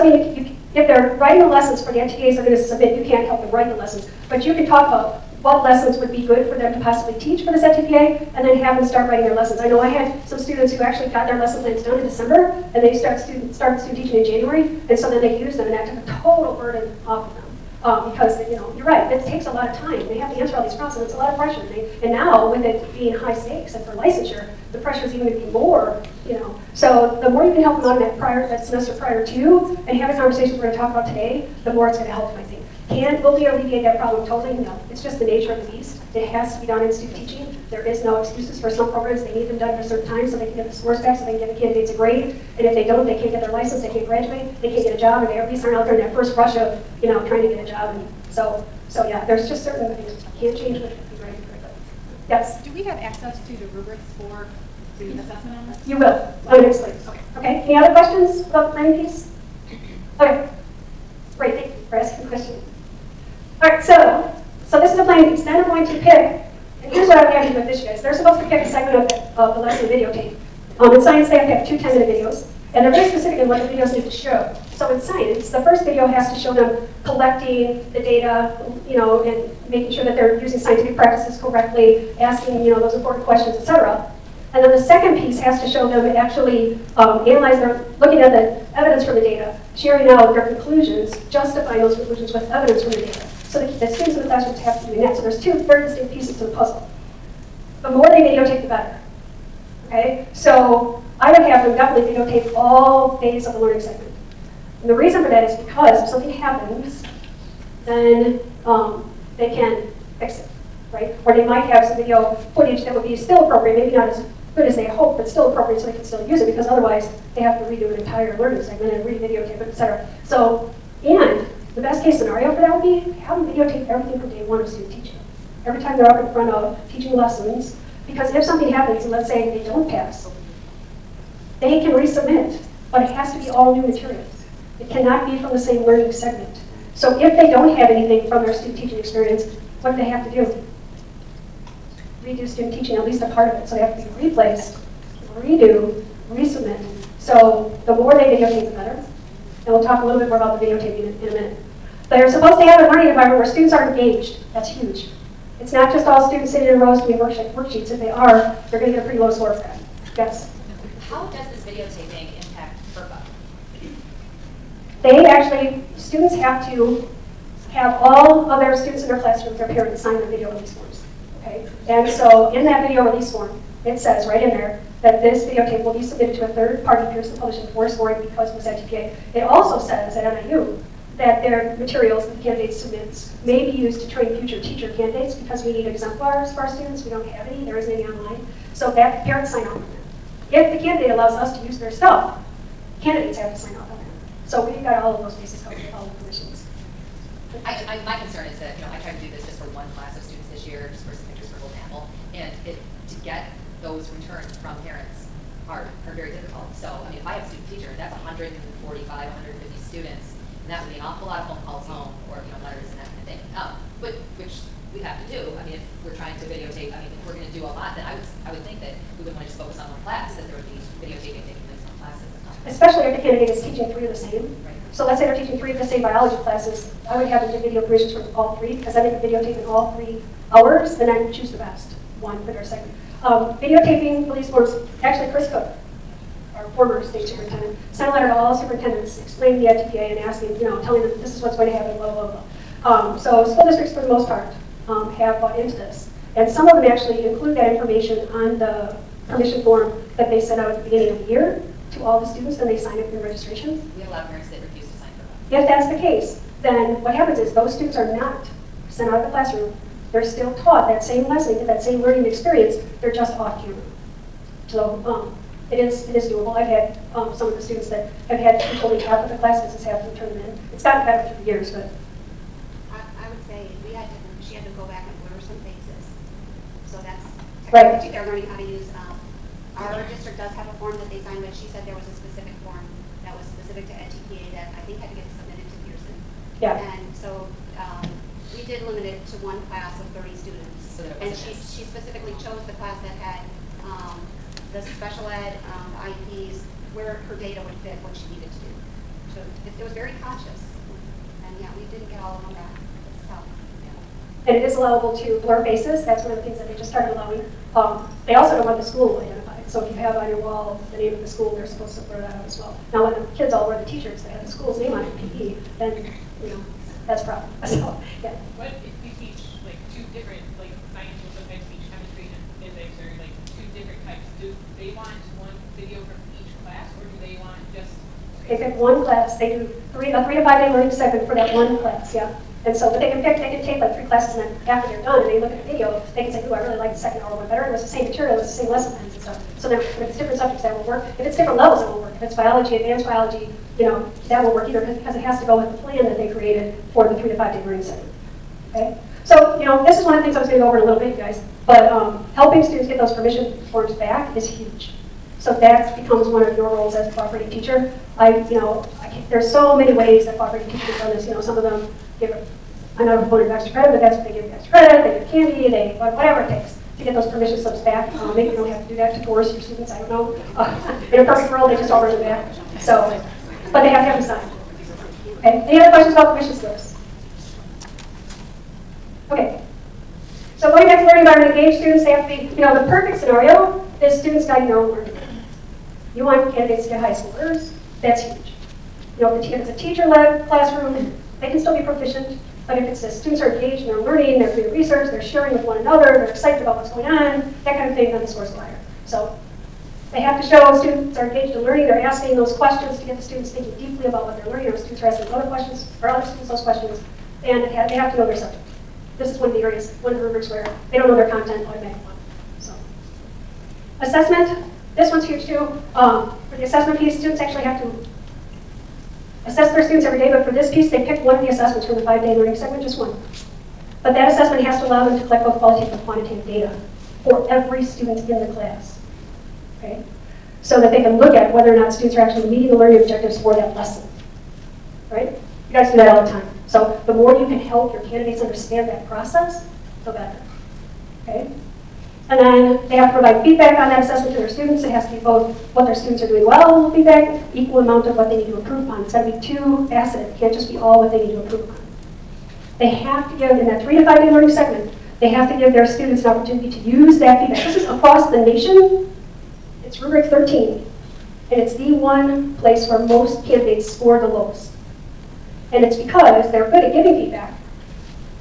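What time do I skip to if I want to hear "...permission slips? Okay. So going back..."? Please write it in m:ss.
6:16.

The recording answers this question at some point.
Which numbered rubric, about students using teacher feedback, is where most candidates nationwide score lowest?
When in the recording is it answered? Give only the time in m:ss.
7:39.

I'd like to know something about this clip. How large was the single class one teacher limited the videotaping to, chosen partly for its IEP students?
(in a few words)
30 students.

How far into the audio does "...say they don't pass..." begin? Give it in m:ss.
2:09.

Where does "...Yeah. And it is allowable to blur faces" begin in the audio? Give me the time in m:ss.
5:03.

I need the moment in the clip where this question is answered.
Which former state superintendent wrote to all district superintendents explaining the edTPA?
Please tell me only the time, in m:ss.
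3:55.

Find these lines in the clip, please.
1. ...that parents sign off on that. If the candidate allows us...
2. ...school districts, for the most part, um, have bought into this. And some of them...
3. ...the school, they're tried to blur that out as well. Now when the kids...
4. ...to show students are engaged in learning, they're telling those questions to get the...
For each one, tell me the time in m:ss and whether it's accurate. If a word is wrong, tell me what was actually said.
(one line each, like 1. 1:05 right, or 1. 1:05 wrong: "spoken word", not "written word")
1. 3:08 right
2. 4:03 right
3. 5:11 wrong: "supposed", not "tried"
4. 6:40 wrong: "asking", not "telling".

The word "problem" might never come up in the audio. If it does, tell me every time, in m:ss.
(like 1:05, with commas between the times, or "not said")
0:33, 5:17.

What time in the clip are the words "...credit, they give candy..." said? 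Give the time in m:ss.
6:04.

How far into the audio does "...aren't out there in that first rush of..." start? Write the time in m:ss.
0:45.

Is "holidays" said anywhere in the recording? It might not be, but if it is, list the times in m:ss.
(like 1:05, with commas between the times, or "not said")
not said.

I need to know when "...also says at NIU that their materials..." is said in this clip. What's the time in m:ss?
2:59.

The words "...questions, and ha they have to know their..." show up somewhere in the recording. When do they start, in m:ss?
6:46.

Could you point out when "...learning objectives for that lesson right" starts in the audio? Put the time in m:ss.
7:12.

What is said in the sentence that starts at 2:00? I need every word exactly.
So, and the best case scenario for that would be have them videotape everything from day one of student teaching.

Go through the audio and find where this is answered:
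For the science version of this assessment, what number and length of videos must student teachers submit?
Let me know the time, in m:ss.
1:11.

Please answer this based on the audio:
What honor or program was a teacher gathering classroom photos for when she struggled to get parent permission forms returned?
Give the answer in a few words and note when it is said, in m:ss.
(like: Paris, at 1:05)
Golden Apple, at 3:21.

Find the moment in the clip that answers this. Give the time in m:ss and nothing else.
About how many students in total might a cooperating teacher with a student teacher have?
3:28.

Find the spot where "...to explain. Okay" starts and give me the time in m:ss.
0:56.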